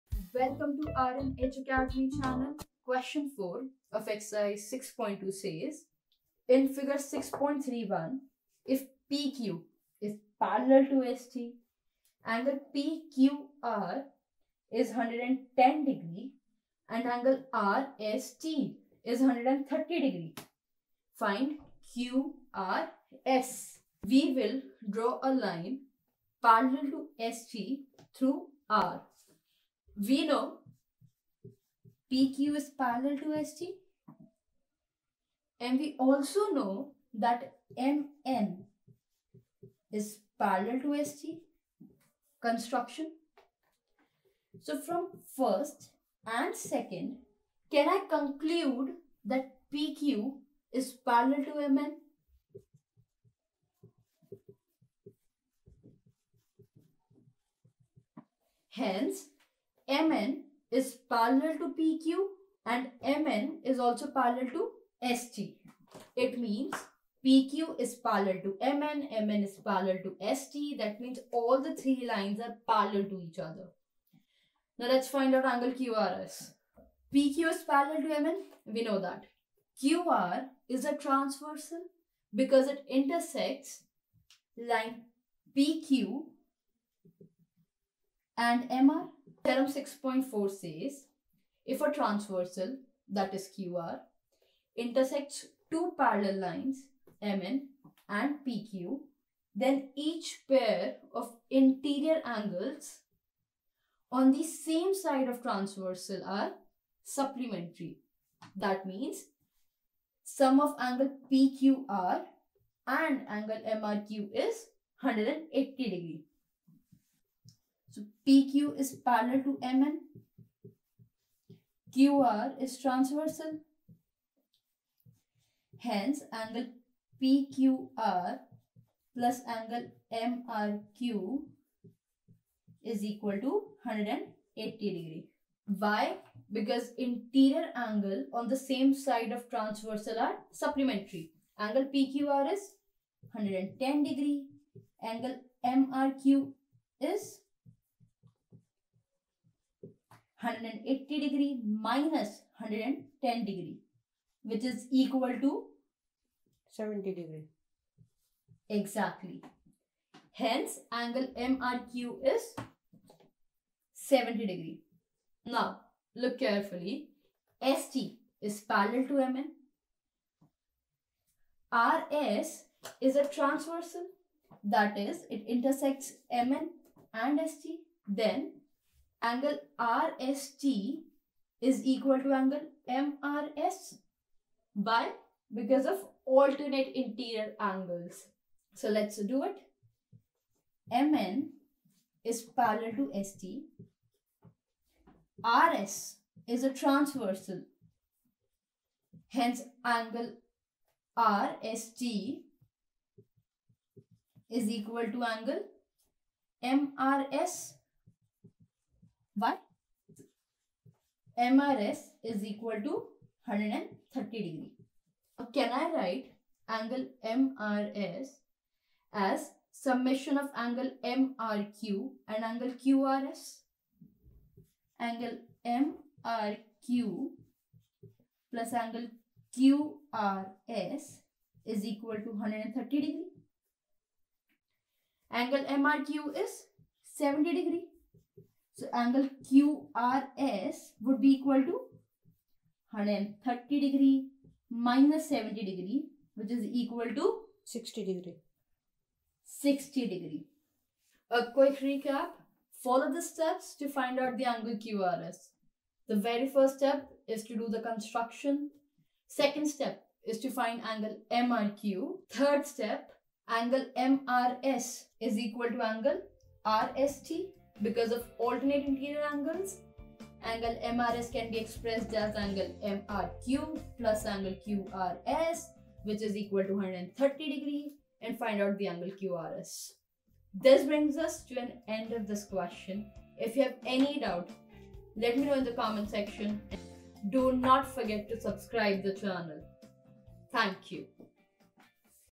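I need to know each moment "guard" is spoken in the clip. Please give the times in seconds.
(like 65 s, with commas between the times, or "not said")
not said.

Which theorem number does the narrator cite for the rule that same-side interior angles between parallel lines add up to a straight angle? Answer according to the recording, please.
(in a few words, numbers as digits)
Theorem 6.4.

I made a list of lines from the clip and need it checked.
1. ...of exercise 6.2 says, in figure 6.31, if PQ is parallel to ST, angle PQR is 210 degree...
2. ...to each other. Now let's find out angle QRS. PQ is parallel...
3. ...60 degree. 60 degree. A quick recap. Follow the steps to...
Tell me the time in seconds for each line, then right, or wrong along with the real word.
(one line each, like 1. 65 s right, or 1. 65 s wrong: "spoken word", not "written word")
1. 3 s wrong: "110", not "210"
2. 73 s right
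3. 247 s right.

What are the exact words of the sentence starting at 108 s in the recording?
That means sum of angle PQR and angle MRQ is 180 degree.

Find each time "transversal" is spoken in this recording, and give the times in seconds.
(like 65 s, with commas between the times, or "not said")
80 s, 91 s, 105 s, 122 s, 139 s, 173 s, 196 s.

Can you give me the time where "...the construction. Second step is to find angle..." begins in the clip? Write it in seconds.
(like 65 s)
257 s.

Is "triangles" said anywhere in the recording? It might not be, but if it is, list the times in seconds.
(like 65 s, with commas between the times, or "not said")
not said.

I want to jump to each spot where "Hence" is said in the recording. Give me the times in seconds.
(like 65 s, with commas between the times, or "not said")
58 s, 125 s, 160 s, 199 s.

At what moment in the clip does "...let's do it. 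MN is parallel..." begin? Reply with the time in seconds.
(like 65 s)
188 s.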